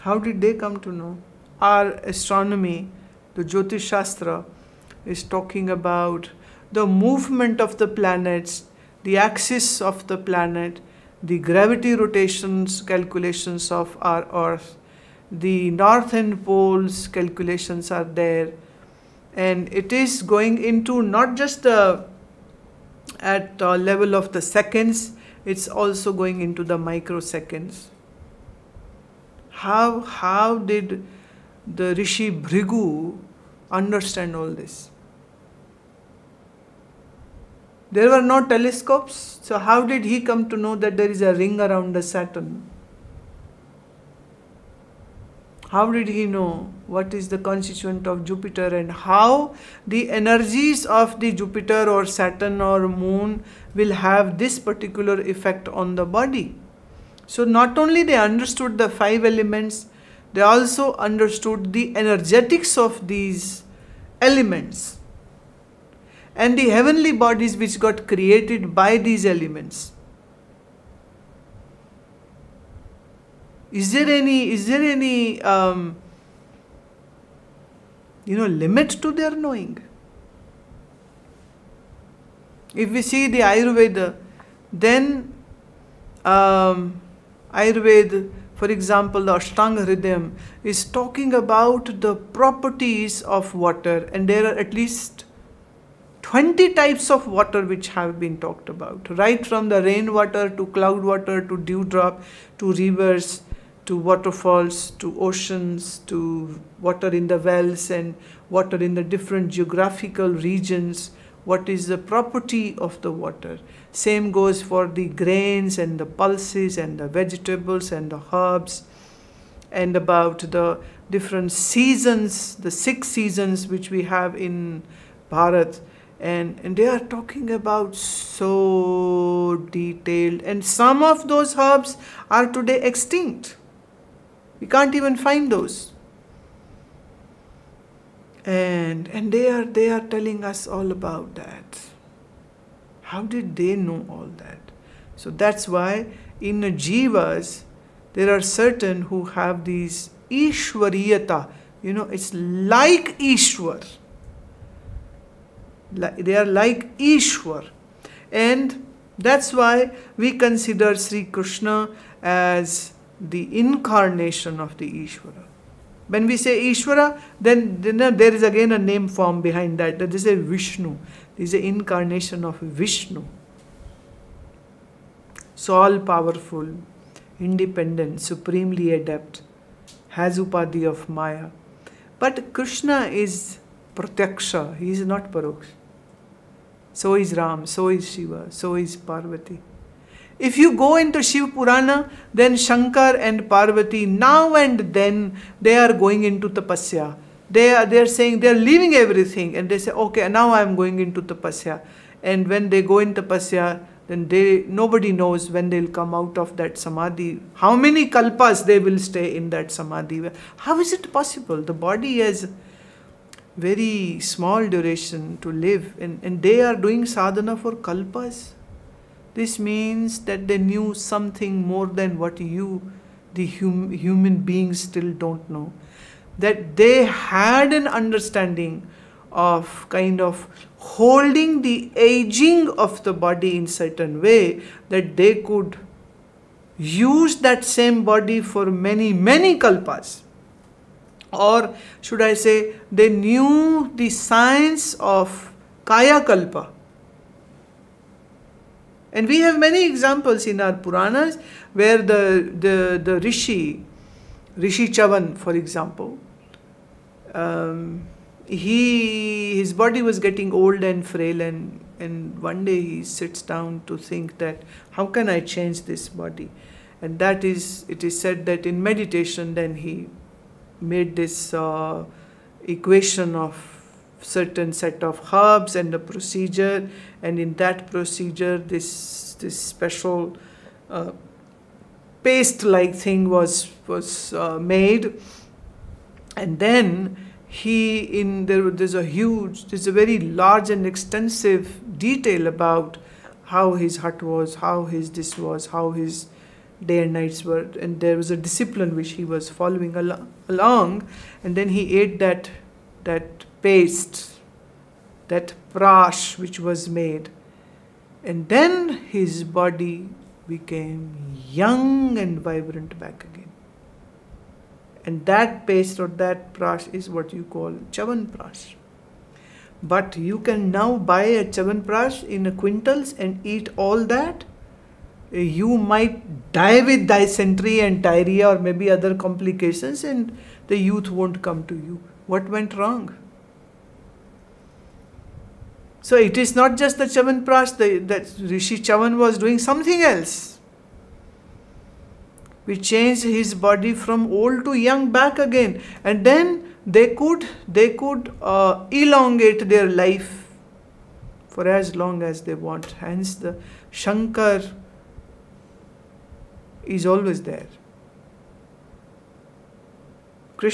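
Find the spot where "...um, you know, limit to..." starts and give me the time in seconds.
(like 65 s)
75 s.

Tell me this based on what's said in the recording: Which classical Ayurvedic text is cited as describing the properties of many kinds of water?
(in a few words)
Ashtanga Hridayam.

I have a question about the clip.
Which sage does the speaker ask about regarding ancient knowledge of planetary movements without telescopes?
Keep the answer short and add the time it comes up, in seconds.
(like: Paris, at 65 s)
Rishi Bhrigu, at 31 s.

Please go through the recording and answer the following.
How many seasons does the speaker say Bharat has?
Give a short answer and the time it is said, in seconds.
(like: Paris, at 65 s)
6, at 122 s.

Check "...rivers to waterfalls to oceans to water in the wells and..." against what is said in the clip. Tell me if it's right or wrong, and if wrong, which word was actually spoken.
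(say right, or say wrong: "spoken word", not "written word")
right.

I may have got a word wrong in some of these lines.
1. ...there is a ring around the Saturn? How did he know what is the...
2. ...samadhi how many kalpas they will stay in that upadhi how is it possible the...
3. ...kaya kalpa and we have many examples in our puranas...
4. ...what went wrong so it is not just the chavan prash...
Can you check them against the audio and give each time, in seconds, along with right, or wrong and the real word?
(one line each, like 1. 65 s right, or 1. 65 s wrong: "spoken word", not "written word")
1. 40 s right
2. 206 s wrong: "samadhi", not "upadhi"
3. 245 s right
4. 332 s right.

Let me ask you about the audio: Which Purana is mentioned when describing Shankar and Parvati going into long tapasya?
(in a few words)
Shiv Purana.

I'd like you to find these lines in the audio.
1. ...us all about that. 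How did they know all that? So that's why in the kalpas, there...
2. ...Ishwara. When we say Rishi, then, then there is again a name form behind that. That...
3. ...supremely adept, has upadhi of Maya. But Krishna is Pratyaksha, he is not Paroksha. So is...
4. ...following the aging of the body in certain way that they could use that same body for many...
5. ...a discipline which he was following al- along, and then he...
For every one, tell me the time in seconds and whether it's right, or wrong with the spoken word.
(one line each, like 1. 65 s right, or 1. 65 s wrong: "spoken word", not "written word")
1. 140 s wrong: "jivas", not "kalpas"
2. 164 s wrong: "Ishwara", not "Rishi"
3. 178 s right
4. 230 s wrong: "holding", not "following"
5. 298 s right.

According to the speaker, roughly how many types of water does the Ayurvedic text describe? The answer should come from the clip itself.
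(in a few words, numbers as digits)
20.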